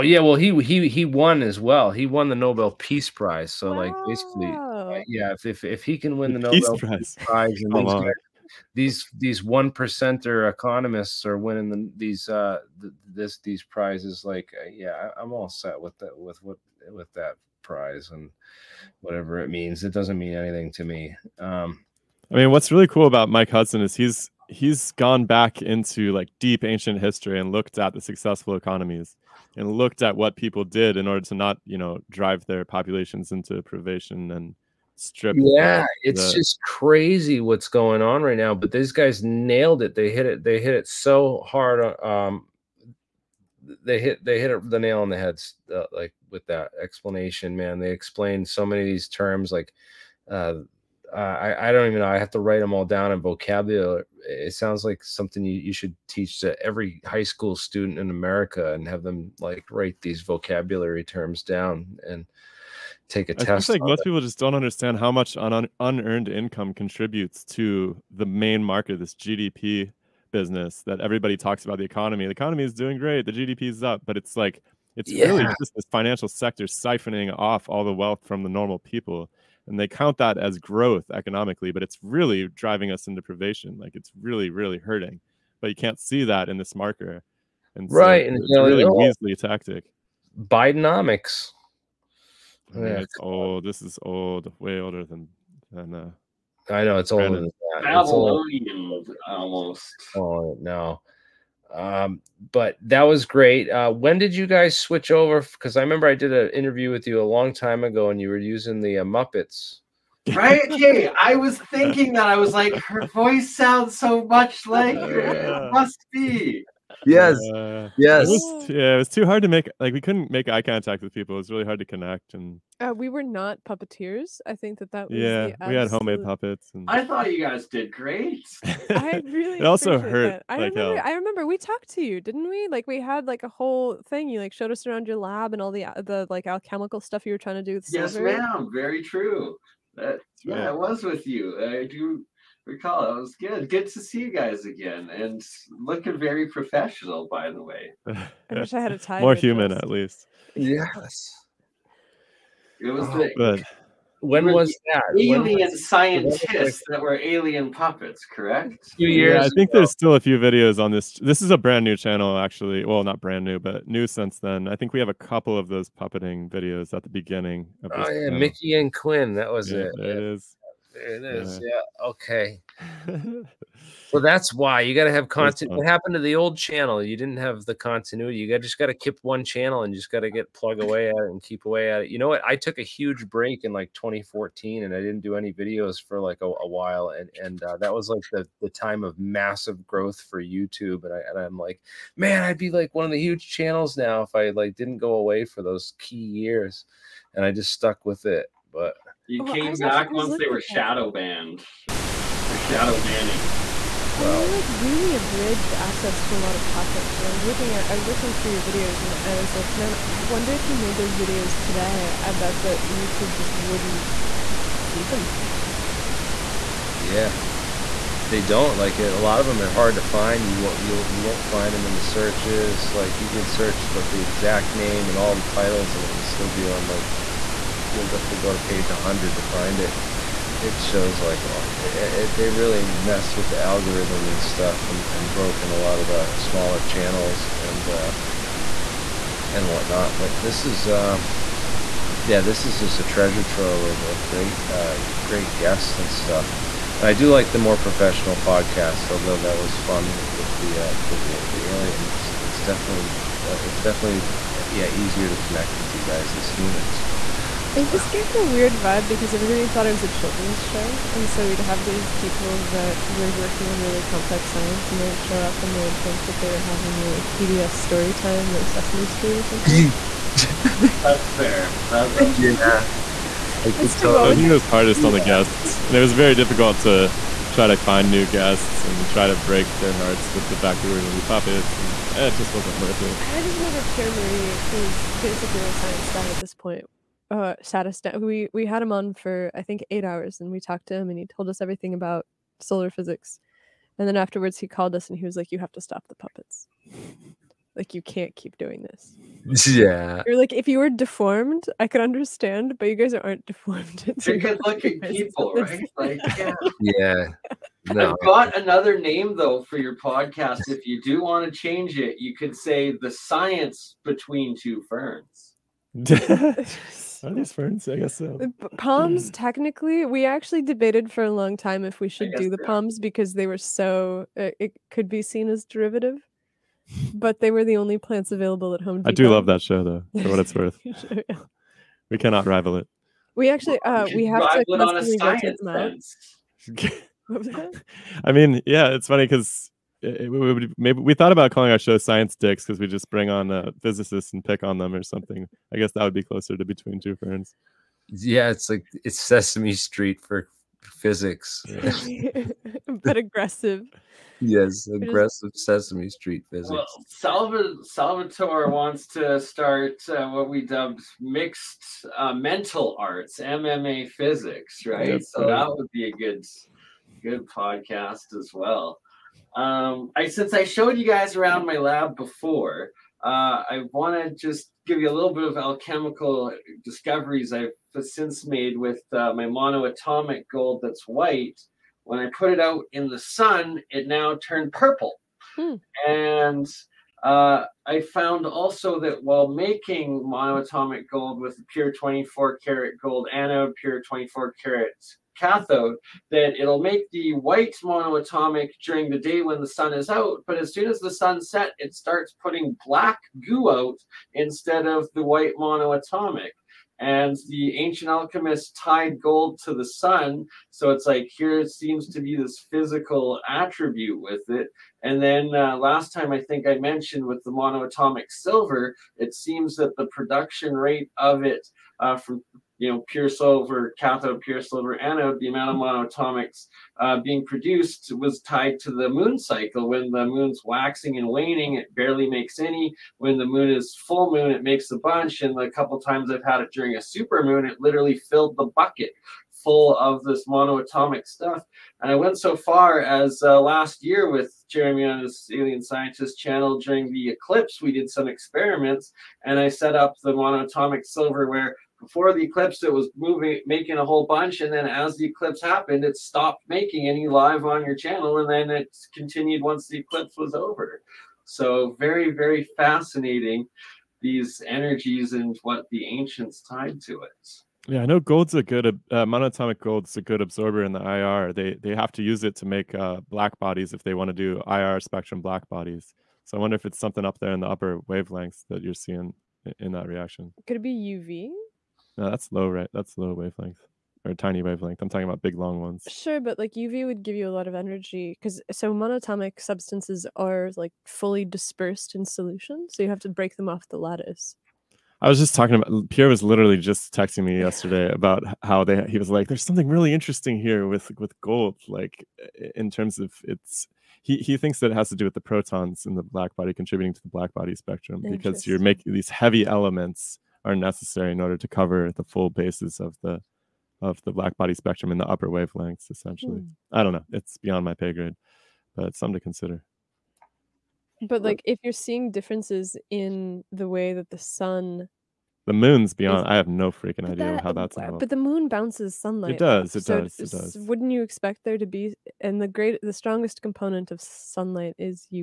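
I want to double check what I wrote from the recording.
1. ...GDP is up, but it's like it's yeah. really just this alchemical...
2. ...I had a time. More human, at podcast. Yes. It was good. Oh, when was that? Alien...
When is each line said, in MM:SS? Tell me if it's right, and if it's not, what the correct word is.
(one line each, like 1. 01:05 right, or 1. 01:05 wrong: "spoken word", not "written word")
1. 01:13 wrong: "financial", not "alchemical"
2. 02:28 wrong: "least", not "podcast".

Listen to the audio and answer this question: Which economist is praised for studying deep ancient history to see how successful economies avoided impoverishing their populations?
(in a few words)
Mike Hudson.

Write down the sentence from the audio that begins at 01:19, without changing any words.
And they count that as growth economically, but it's really driving us into privation.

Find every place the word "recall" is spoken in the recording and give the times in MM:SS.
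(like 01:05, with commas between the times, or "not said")
02:22.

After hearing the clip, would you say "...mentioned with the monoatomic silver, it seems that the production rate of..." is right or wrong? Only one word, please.
right.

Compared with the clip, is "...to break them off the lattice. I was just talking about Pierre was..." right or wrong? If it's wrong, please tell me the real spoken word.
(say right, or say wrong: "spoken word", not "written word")
right.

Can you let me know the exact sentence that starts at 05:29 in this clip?
I do love that show though, for what it's worth.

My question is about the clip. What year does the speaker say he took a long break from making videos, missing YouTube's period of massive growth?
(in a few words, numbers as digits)
2014.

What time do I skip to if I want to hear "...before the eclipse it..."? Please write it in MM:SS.
07:31.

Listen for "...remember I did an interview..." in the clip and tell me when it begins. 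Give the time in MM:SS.
01:45.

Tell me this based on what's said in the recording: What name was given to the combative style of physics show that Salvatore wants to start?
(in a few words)
MMA physics.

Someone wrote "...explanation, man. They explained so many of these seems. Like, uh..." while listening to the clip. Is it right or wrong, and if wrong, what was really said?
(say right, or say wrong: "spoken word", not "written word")
wrong: "terms", not "seems".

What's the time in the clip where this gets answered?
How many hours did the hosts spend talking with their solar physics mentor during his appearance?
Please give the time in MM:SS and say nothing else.
04:49.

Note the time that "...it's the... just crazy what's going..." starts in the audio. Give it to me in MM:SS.
00:36.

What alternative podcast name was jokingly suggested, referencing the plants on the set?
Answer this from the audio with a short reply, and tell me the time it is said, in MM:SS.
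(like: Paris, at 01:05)
Science Between Two Ferns, at 05:12.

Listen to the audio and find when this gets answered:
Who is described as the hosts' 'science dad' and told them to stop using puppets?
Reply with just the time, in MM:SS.
04:43.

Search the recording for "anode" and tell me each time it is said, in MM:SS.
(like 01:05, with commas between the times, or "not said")
06:33, 07:04.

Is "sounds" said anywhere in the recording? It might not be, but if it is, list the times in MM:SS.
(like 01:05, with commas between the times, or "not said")
00:54, 01:53.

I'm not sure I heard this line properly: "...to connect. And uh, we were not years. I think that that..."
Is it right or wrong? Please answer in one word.
wrong.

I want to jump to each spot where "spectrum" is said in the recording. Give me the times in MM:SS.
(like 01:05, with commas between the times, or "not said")
07:54, 08:27, 08:34.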